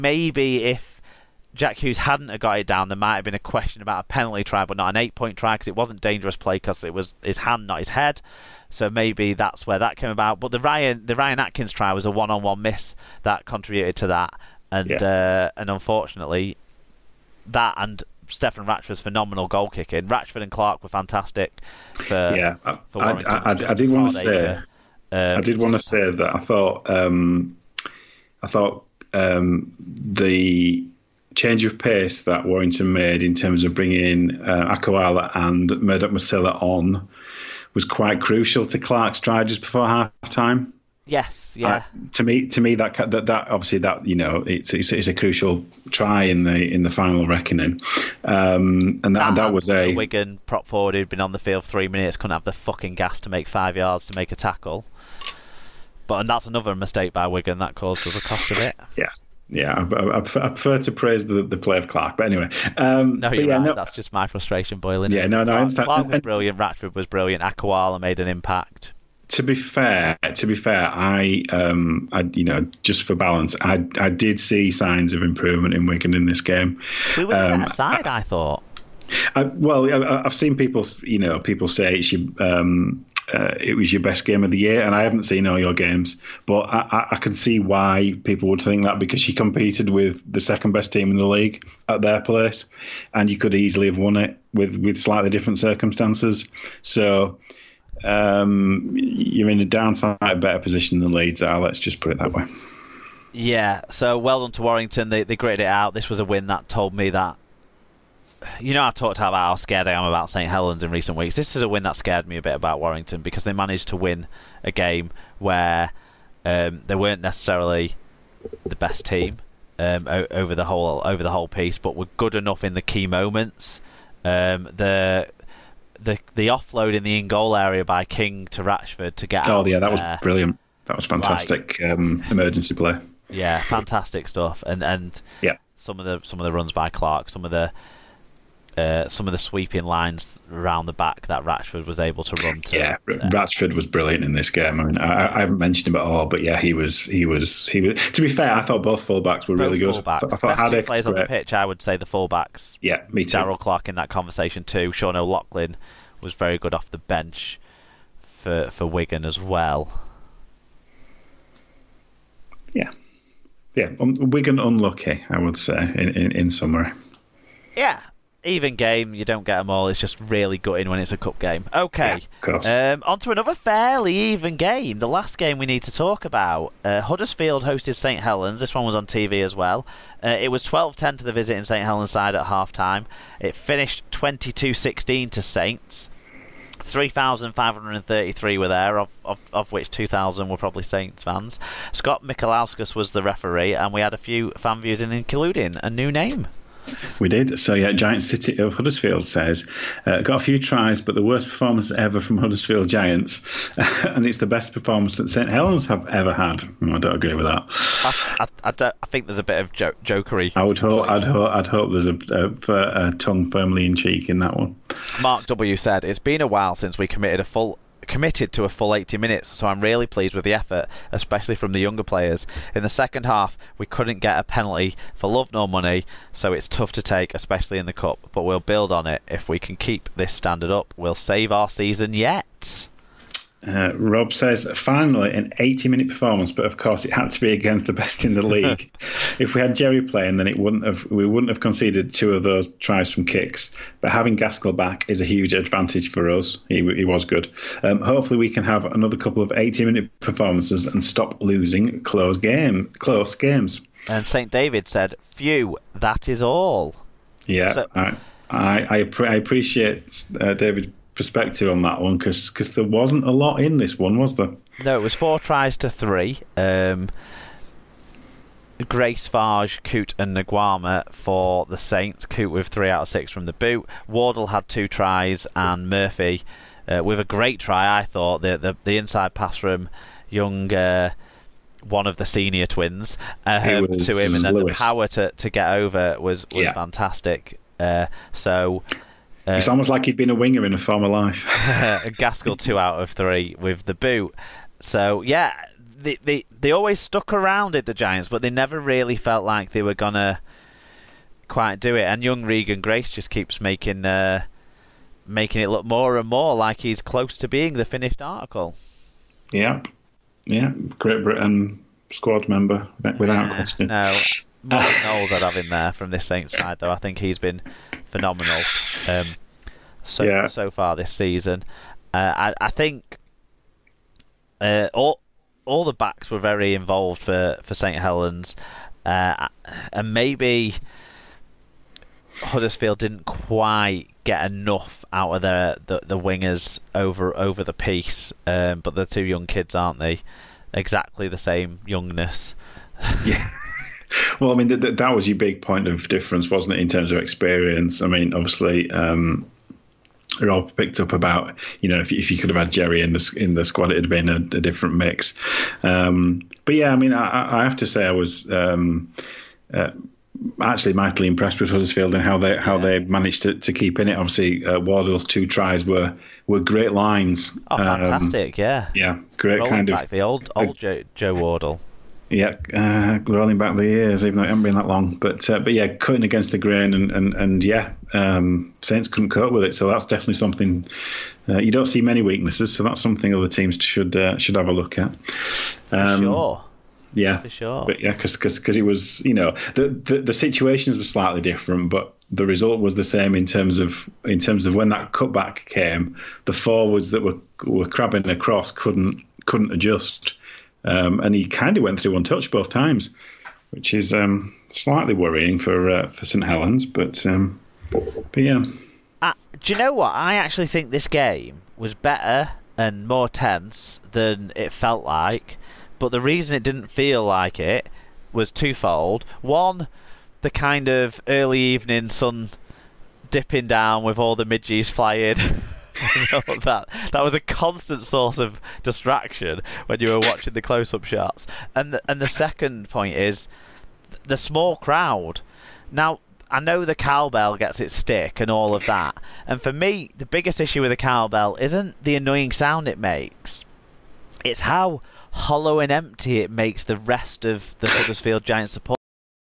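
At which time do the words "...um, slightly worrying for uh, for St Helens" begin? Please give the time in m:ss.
6:44.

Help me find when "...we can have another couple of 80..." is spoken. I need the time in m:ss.
4:08.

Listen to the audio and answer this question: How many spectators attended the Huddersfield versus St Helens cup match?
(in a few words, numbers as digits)
3,533.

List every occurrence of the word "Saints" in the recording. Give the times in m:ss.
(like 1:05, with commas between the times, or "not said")
3:05, 3:10, 4:31, 5:16, 6:18.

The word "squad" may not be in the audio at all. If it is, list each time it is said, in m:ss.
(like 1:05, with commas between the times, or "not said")
5:12, 5:53.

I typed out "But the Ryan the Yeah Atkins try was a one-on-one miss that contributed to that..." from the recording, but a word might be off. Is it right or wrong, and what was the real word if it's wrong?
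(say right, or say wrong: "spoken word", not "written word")
wrong: "Ryan", not "Yeah".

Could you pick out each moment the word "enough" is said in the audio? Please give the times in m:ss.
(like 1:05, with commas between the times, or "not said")
2:02, 5:34.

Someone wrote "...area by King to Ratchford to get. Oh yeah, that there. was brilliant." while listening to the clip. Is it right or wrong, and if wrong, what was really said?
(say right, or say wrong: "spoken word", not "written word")
right.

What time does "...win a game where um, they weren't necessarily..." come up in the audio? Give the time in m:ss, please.
1:53.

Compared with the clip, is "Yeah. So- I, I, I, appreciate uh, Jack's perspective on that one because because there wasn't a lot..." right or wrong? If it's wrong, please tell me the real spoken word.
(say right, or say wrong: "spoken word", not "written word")
wrong: "David", not "Jack".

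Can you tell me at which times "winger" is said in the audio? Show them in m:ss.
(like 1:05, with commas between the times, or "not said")
4:50, 5:36.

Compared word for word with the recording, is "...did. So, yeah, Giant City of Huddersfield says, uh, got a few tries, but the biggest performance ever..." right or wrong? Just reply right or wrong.
wrong.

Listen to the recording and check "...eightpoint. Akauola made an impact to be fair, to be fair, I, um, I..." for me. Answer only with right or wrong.
wrong.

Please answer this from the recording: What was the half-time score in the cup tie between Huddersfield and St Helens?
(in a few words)
12-10.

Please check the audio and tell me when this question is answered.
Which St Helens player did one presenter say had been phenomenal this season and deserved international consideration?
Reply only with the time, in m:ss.
5:14.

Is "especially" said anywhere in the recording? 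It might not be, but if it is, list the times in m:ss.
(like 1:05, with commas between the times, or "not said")
3:41, 3:47.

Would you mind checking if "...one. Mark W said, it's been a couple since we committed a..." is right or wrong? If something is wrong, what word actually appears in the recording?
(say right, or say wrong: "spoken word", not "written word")
wrong: "while", not "couple".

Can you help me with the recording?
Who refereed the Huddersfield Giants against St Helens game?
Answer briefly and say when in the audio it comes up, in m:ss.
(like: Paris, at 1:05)
Scott Mikalauskas, at 3:11.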